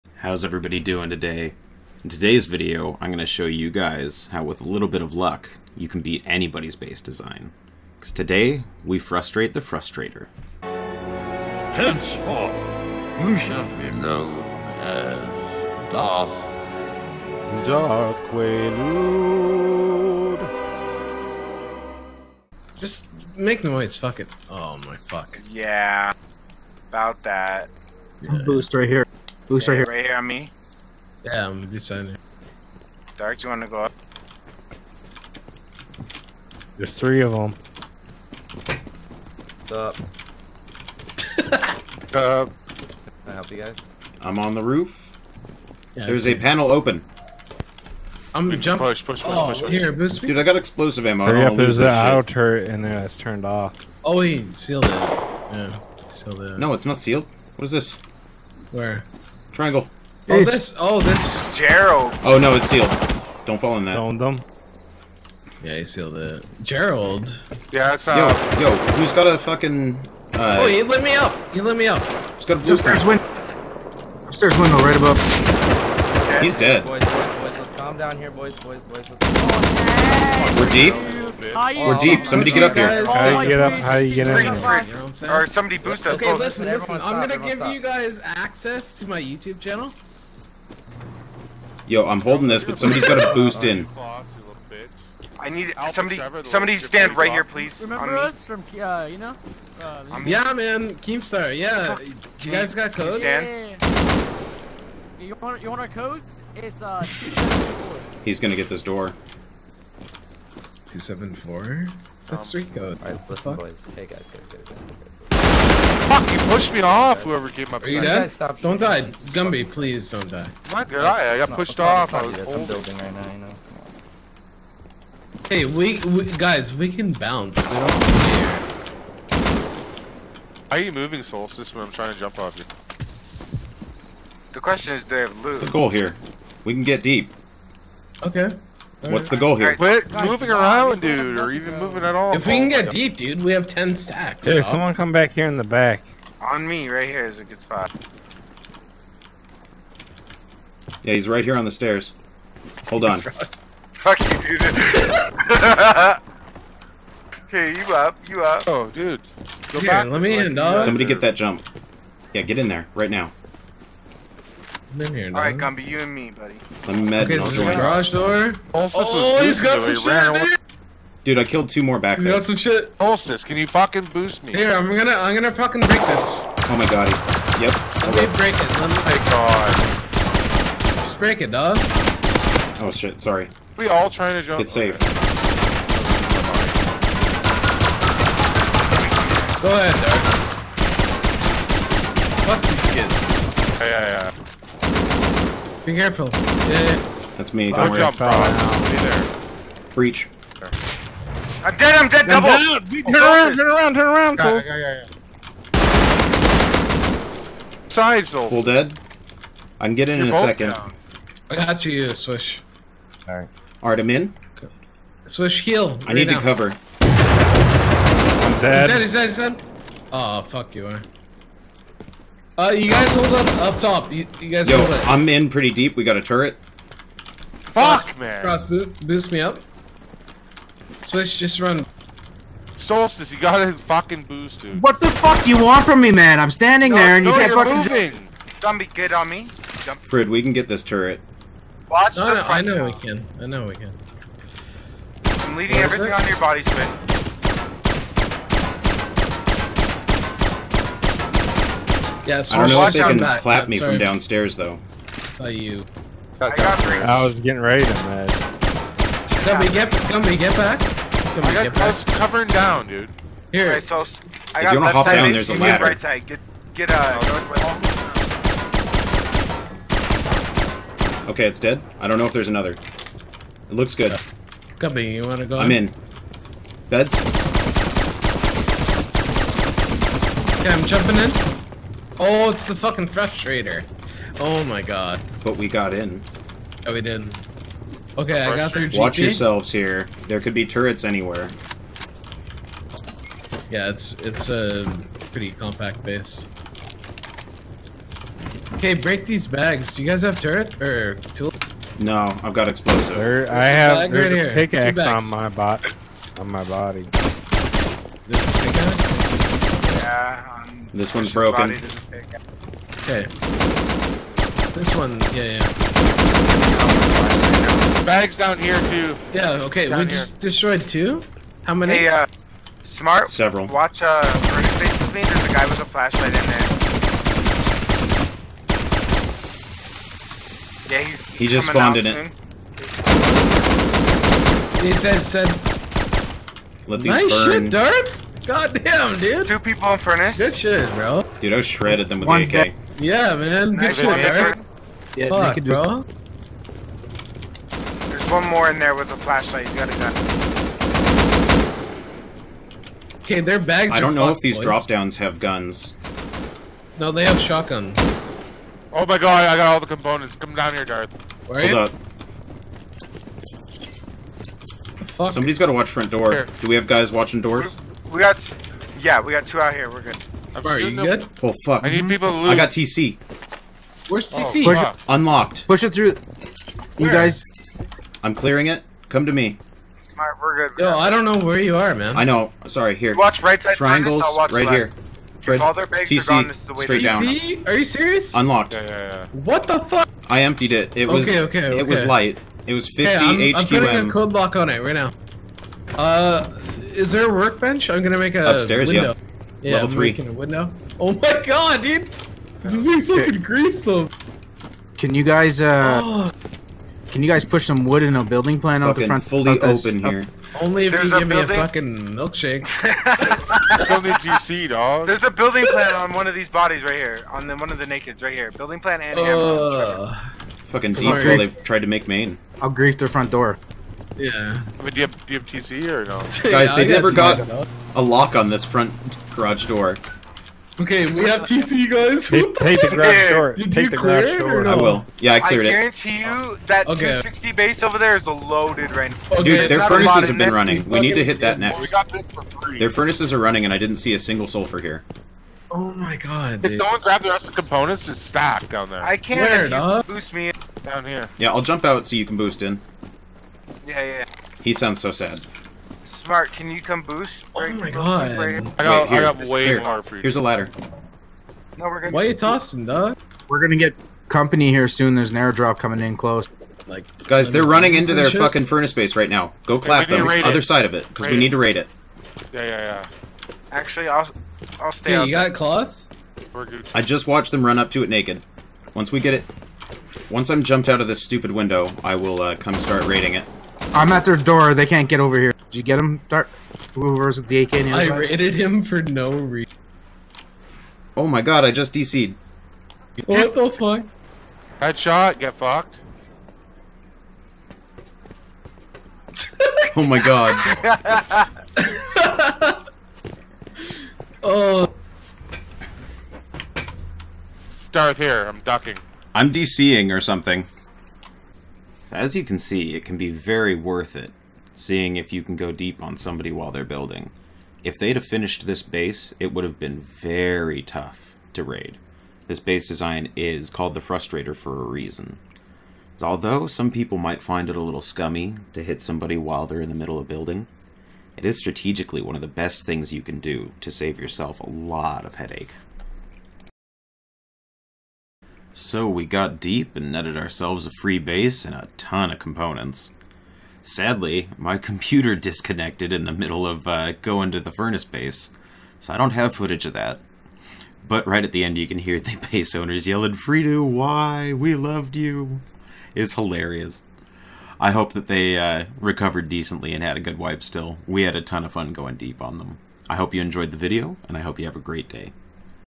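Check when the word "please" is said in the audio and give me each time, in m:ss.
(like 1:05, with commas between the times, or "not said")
1:37, 1:59.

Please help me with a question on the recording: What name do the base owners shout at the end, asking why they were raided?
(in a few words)
Freedo.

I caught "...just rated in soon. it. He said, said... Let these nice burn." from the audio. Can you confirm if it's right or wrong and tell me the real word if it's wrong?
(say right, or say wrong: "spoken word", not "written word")
wrong: "spawned", not "rated".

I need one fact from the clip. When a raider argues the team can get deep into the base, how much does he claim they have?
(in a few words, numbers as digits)
10 stacks.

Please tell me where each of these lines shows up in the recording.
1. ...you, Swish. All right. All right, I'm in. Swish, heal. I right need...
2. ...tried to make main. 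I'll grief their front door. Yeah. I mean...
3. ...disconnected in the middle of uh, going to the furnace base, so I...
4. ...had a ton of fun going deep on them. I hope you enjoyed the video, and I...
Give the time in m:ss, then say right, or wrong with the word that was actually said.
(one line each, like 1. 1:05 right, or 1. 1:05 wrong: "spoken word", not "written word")
1. 3:31 right
2. 7:01 right
3. 9:05 right
4. 9:21 right.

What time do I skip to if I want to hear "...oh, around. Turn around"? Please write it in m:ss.
3:23.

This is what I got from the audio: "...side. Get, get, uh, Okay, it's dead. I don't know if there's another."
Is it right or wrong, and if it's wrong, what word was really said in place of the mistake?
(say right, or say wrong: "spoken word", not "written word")
right.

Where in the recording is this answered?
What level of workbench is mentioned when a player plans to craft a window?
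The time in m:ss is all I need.
6:39.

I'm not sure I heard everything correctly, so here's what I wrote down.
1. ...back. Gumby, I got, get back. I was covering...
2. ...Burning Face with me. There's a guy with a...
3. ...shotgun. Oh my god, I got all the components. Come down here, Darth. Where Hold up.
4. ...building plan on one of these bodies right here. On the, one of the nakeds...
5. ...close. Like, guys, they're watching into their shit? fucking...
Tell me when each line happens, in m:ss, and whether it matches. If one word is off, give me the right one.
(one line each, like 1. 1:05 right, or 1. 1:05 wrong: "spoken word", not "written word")
1. 4:20 right
2. 5:24 right
3. 5:57 right
4. 6:55 right
5. 7:46 wrong: "running", not "watching".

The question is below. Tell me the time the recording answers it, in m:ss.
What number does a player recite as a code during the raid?
1:50.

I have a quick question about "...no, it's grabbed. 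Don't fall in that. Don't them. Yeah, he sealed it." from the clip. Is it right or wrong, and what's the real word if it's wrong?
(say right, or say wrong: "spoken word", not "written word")
wrong: "sealed", not "grabbed".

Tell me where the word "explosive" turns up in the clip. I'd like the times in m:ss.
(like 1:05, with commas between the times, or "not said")
0:50, 5:02.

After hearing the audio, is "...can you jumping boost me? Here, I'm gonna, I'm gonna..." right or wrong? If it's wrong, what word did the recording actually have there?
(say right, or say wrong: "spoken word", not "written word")
wrong: "fucking", not "jumping".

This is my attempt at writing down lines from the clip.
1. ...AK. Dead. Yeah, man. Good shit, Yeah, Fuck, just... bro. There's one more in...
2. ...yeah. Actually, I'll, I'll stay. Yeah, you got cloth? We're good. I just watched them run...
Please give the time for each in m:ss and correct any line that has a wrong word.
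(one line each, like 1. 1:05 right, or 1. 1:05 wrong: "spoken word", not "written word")
1. 5:42 right
2. 7:52 right.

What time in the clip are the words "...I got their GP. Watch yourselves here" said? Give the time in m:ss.
4:48.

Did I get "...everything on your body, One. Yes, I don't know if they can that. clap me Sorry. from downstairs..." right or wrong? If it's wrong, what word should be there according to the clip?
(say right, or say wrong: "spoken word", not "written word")
wrong: "Spin", not "One".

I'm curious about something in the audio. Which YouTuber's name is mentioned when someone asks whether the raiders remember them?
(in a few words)
Keemstar.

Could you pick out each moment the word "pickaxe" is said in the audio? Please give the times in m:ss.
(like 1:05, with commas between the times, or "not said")
5:04, 5:08.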